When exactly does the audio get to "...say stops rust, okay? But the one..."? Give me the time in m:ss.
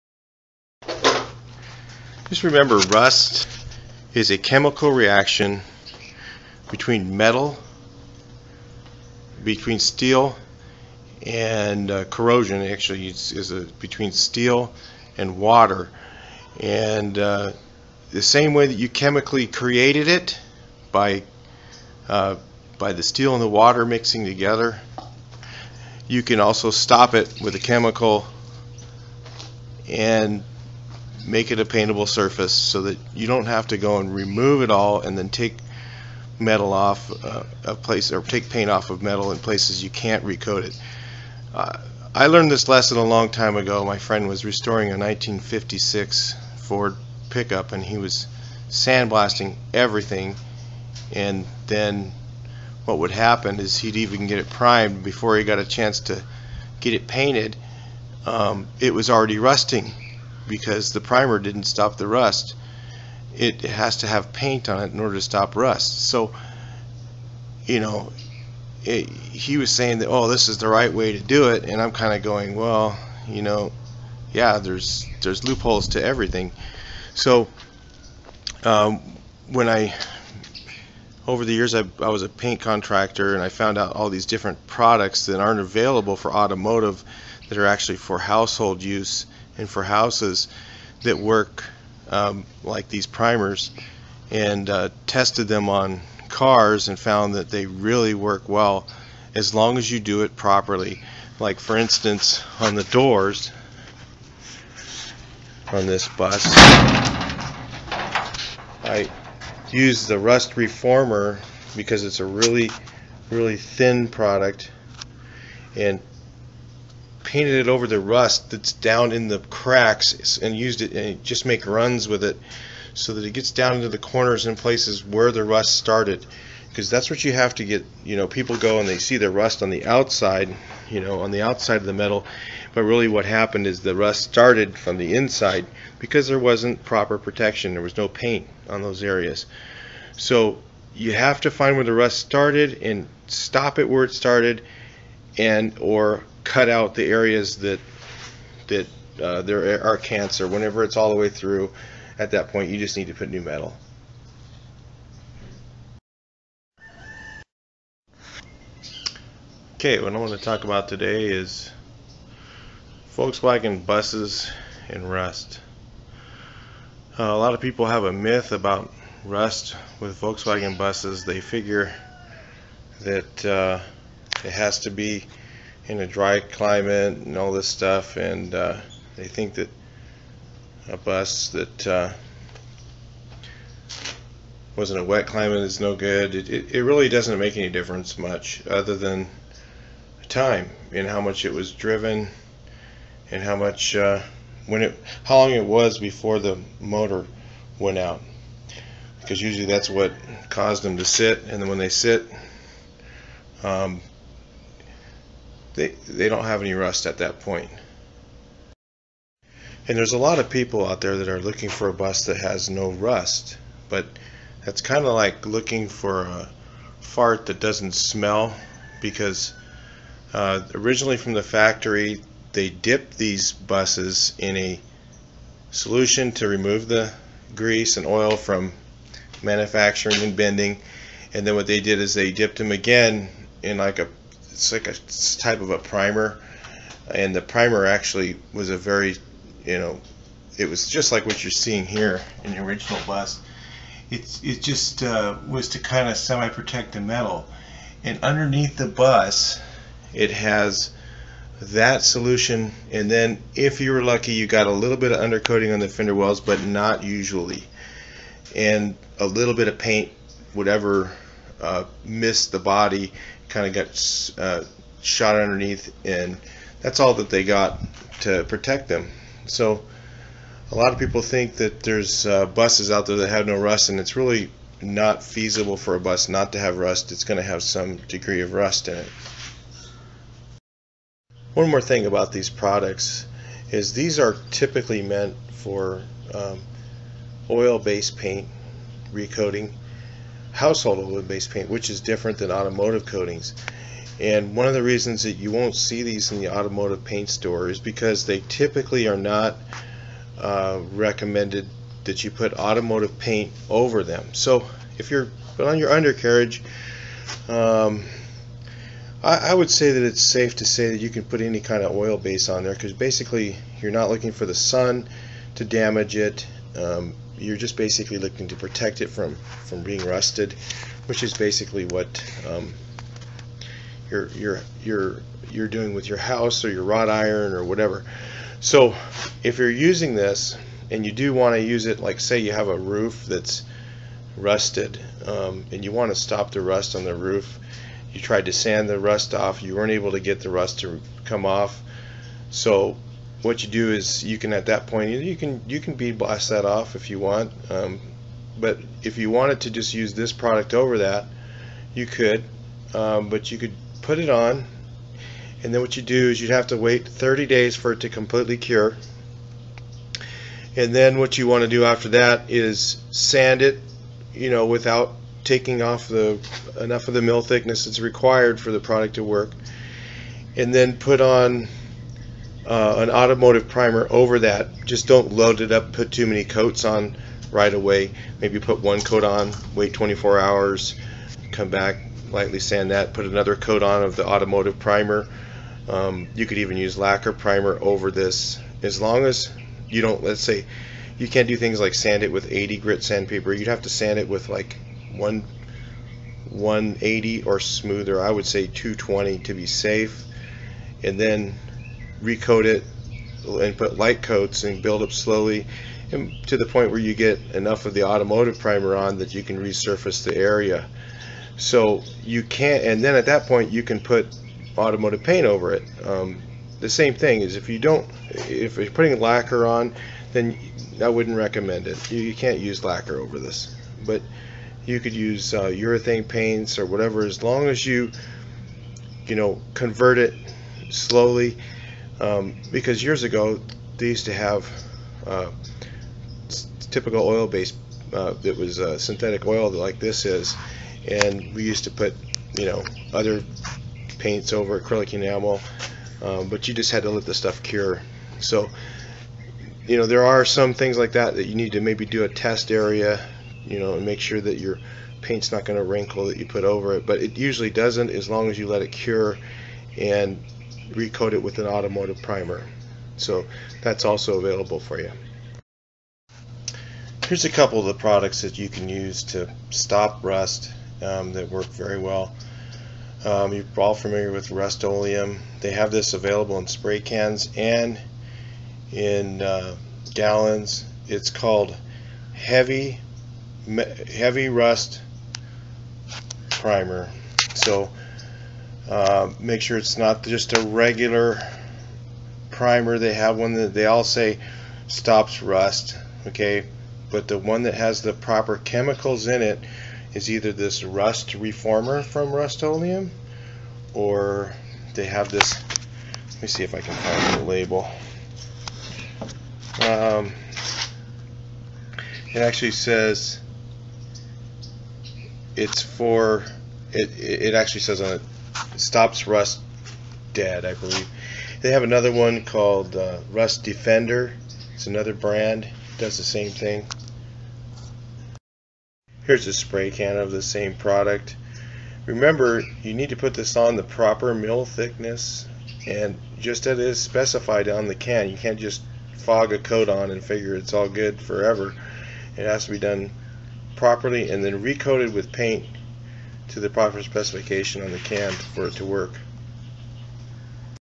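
8:14.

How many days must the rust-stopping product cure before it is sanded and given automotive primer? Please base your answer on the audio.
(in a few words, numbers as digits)
30 days.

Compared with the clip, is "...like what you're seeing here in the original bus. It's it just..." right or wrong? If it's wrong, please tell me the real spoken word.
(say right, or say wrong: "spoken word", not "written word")
right.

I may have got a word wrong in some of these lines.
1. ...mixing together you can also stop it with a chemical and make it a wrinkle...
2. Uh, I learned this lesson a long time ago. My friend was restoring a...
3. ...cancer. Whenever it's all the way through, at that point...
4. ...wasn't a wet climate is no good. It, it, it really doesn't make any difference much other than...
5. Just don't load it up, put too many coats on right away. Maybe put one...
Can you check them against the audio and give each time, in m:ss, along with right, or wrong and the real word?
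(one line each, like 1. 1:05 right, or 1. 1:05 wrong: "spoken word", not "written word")
1. 0:23 wrong: "paintable", not "wrinkle"
2. 0:41 right
3. 2:29 right
4. 3:04 right
5. 6:14 right.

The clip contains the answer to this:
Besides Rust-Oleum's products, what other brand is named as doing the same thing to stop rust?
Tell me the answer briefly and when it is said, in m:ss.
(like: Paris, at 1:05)
Rust Defender, at 8:43.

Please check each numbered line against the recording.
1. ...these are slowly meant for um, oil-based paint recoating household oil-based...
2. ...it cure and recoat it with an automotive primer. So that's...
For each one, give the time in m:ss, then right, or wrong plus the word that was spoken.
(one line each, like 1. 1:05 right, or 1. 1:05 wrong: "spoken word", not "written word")
1. 4:43 wrong: "typically", not "slowly"
2. 7:38 right.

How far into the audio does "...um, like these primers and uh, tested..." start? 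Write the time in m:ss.
1:32.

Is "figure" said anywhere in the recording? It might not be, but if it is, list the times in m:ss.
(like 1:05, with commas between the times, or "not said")
2:51, 9:00.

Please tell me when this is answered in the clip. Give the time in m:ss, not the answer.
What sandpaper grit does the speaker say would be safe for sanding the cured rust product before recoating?
6:38.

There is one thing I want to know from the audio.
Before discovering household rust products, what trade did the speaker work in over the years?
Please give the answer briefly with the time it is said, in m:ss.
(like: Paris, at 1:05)
paint contractor, at 1:22.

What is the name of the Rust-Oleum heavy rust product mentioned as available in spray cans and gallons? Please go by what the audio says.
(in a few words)
Heavy Rust Primer.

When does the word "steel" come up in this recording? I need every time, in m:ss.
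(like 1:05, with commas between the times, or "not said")
0:09, 0:14, 0:23.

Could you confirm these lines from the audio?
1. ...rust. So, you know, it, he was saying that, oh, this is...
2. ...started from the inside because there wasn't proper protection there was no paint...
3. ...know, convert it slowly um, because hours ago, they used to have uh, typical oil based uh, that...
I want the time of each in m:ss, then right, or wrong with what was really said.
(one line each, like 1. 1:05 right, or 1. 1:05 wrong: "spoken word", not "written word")
1. 1:05 right
2. 2:14 right
3. 7:09 wrong: "years", not "hours".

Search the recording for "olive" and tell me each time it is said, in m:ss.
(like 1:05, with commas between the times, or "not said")
not said.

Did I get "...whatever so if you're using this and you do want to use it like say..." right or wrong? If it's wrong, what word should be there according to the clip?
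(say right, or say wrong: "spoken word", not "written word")
right.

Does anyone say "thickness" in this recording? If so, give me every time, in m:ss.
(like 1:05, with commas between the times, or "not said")
6:07, 8:54.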